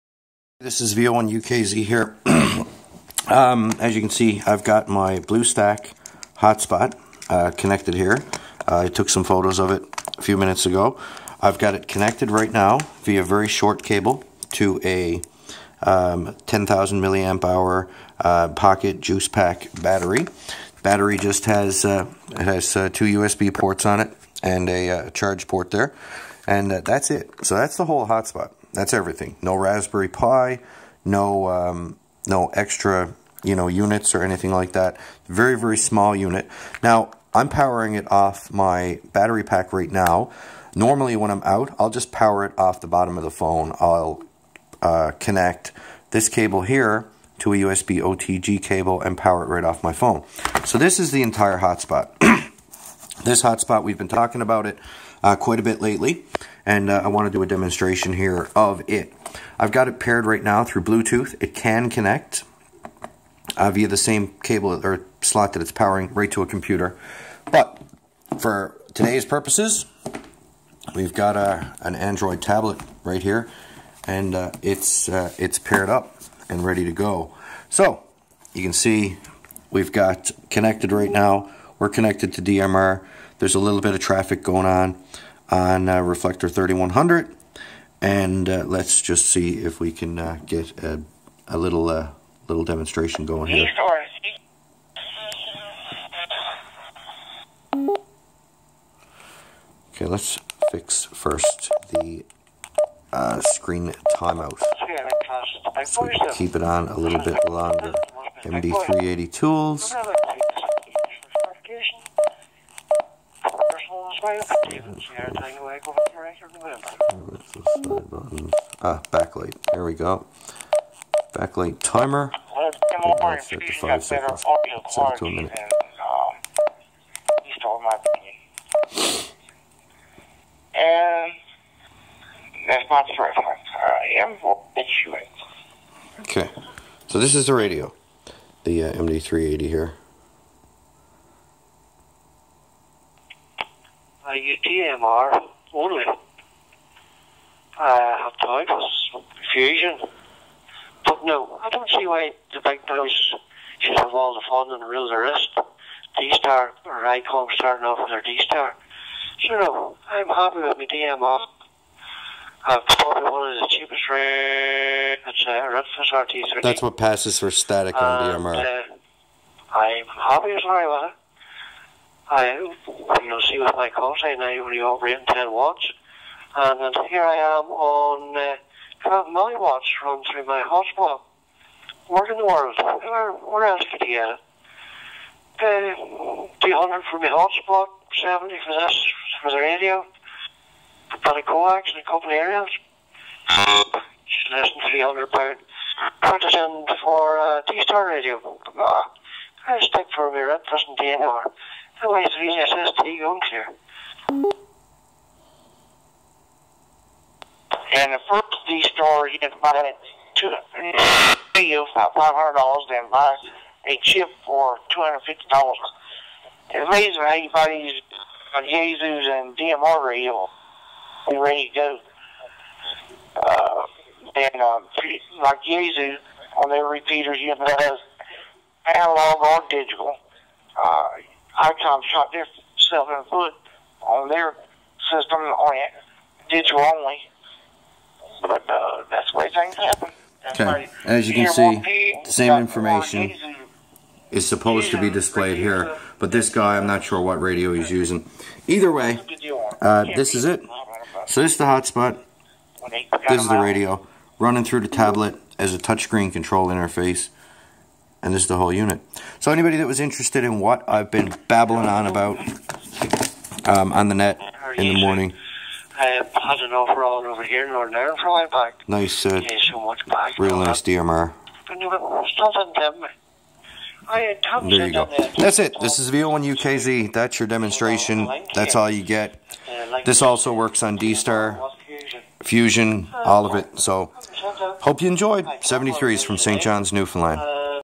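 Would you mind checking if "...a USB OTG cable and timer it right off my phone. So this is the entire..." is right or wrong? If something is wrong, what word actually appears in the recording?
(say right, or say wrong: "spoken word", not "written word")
wrong: "power", not "timer".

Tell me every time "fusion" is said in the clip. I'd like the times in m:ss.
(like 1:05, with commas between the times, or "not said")
2:29, 4:42.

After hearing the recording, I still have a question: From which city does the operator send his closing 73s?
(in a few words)
St. John's, Newfoundland.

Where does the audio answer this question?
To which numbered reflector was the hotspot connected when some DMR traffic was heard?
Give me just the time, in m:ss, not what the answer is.
1:26.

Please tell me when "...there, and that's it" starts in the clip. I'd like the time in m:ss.
0:25.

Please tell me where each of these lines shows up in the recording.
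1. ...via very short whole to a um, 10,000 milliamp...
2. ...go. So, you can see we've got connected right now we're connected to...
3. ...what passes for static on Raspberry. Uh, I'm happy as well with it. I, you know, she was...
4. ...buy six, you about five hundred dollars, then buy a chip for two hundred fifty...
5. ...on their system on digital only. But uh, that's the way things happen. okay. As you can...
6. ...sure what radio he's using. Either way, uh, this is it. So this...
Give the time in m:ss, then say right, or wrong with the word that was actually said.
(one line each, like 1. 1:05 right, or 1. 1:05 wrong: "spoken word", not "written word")
1. 0:13 wrong: "cable", not "whole"
2. 1:16 right
3. 2:46 wrong: "DMR", not "Raspberry"
4. 3:29 wrong: "two", not "six"
5. 3:54 right
6. 4:07 right.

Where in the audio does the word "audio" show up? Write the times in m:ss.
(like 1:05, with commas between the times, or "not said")
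not said.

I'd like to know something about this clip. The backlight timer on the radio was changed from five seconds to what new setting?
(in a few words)
a minute.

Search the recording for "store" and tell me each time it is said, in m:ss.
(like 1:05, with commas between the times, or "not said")
3:28.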